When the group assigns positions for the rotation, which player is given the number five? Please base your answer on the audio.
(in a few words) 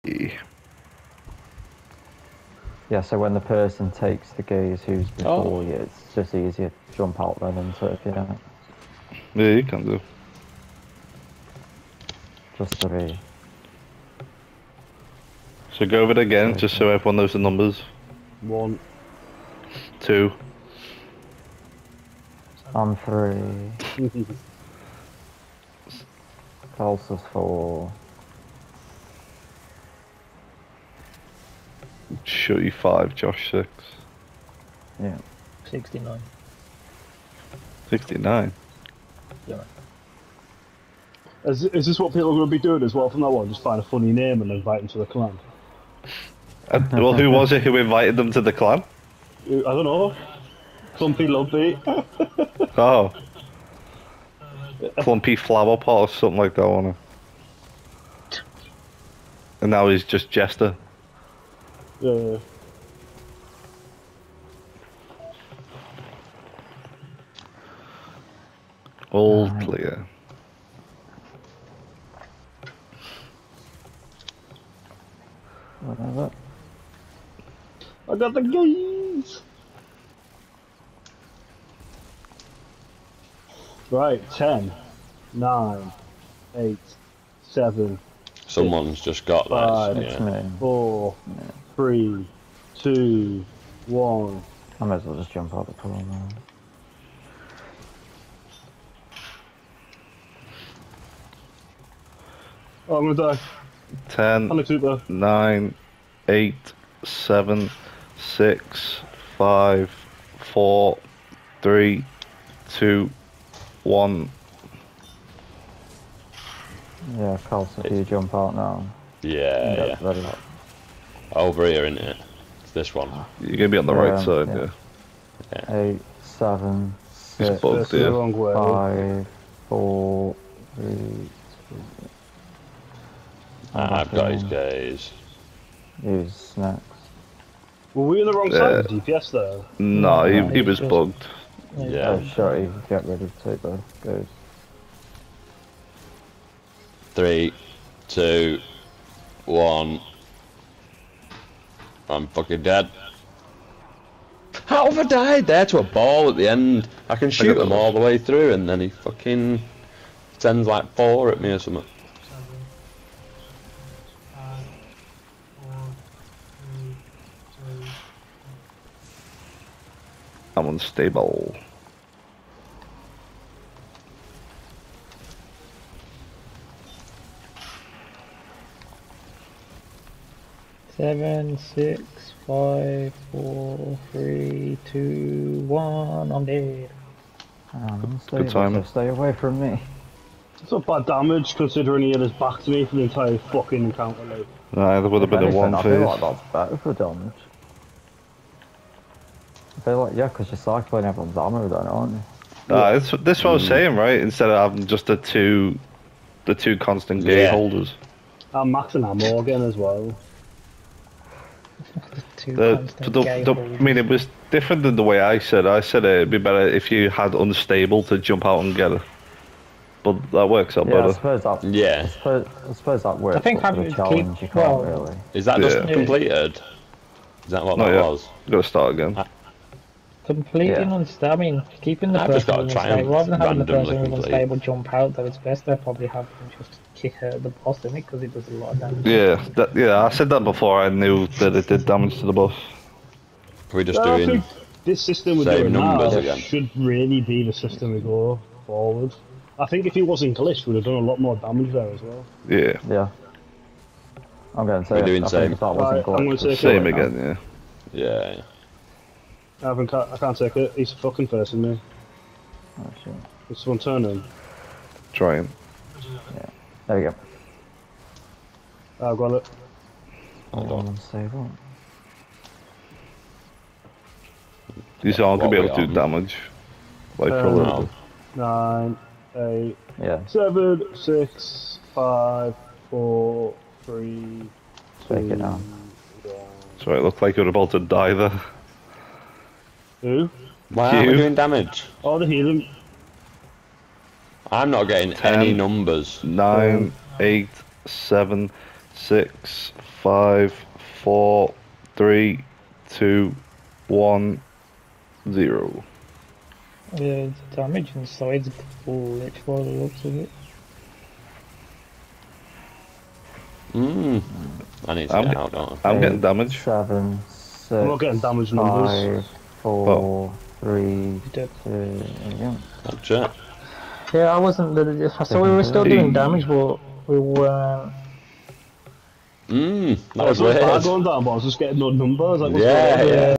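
Shutty.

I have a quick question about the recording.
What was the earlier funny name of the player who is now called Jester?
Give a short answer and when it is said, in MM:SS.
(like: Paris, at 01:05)
Clumpy Flower Pot, at 00:54.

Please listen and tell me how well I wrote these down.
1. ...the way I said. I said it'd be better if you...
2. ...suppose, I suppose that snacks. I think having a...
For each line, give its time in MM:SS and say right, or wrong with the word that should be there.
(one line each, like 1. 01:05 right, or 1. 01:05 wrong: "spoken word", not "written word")
1. 03:34 right
2. 03:42 wrong: "works", not "snacks".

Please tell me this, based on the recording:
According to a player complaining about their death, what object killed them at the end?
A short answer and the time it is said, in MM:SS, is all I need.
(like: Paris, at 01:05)
a ball, at 02:35.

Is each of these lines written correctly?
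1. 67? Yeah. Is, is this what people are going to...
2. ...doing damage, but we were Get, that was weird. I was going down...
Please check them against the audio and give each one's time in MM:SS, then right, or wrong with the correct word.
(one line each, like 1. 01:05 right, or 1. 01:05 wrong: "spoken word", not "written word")
1. 00:37 wrong: "69", not "67"
2. 05:25 wrong: "Mmm", not "Get".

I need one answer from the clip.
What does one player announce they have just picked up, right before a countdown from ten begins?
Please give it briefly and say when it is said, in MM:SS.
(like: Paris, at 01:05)
the keys, at 01:18.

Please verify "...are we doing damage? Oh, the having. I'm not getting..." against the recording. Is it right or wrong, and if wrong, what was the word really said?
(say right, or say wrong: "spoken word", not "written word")
wrong: "healing", not "having".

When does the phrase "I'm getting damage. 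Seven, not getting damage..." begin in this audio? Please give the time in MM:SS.
05:15.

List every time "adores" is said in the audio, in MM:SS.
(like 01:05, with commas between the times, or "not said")
not said.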